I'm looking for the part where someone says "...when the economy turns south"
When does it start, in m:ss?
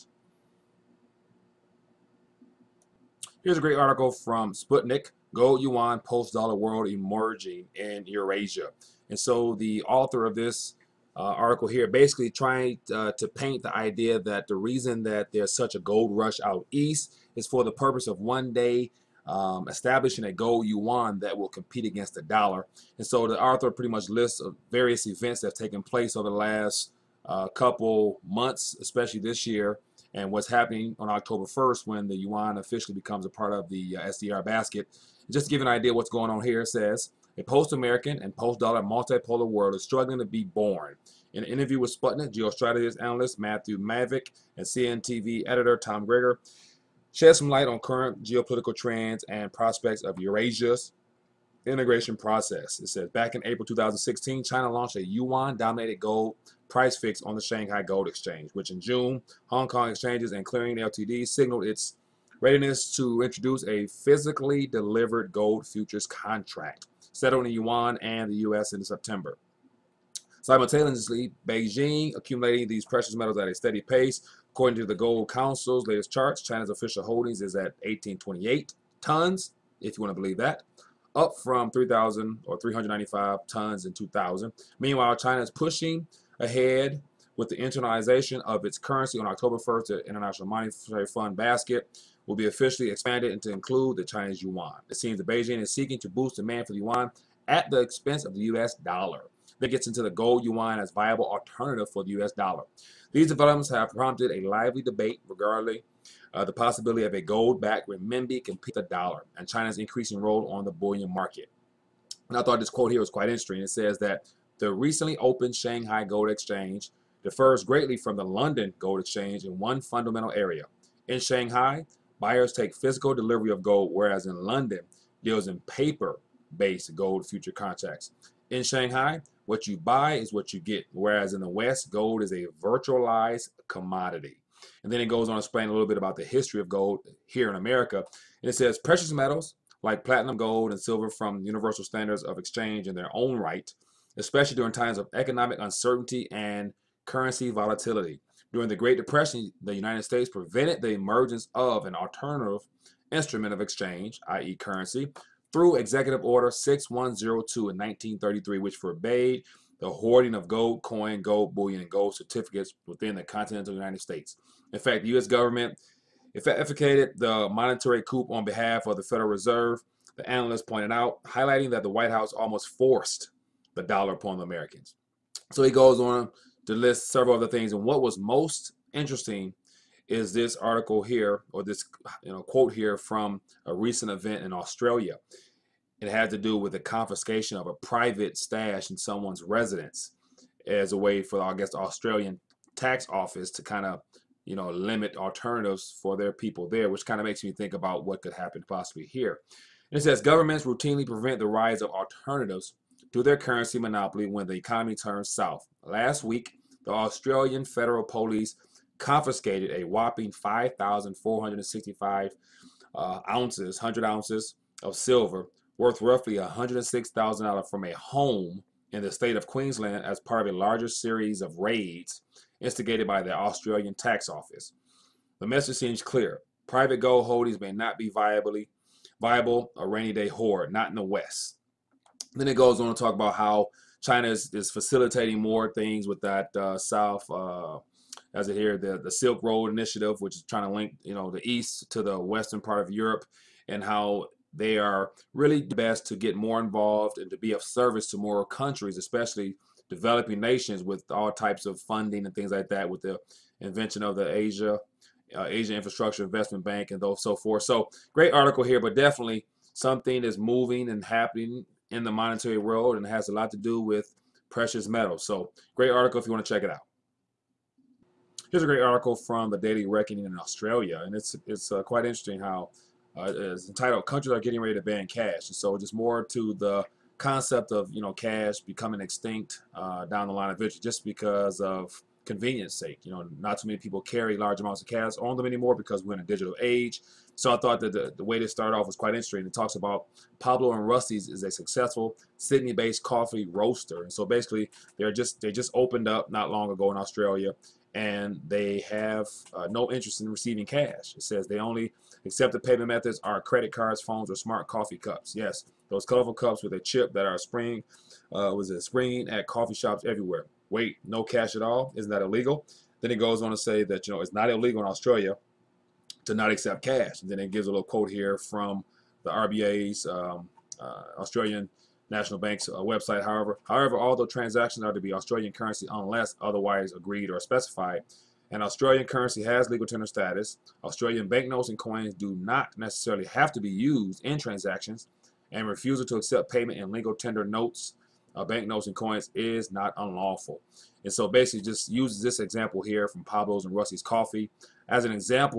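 3:24.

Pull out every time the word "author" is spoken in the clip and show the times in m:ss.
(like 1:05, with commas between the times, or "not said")
0:09, 0:23.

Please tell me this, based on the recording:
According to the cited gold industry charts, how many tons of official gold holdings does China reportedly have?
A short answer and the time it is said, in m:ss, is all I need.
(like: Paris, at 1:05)
1828 tons, at 1:17.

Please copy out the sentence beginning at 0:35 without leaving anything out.
Just to give an idea what's going on here, it says, a post-American and post-dollar multipolar world is struggling to be born.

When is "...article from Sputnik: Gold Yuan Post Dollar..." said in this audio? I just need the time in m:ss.
0:03.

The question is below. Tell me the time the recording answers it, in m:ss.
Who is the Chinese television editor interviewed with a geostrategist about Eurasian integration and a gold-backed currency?
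0:45.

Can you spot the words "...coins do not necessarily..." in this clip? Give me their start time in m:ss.
5:31.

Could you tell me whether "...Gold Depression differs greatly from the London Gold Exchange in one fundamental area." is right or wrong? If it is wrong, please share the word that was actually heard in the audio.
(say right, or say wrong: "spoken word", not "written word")
wrong: "Exchange", not "Depression".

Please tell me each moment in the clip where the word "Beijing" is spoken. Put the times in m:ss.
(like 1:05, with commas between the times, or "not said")
1:11, 1:35.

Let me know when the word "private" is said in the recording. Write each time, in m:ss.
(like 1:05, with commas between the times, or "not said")
3:07, 3:46.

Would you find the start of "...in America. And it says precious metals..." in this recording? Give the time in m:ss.
2:17.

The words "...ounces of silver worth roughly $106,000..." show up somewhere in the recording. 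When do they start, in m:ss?
3:34.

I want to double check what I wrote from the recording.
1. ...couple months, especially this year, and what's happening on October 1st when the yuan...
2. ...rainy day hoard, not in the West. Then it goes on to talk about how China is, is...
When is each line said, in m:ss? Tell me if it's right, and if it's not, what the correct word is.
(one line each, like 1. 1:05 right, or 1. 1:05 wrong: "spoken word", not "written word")
1. 0:27 right
2. 3:49 right.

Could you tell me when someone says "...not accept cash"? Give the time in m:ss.
5:16.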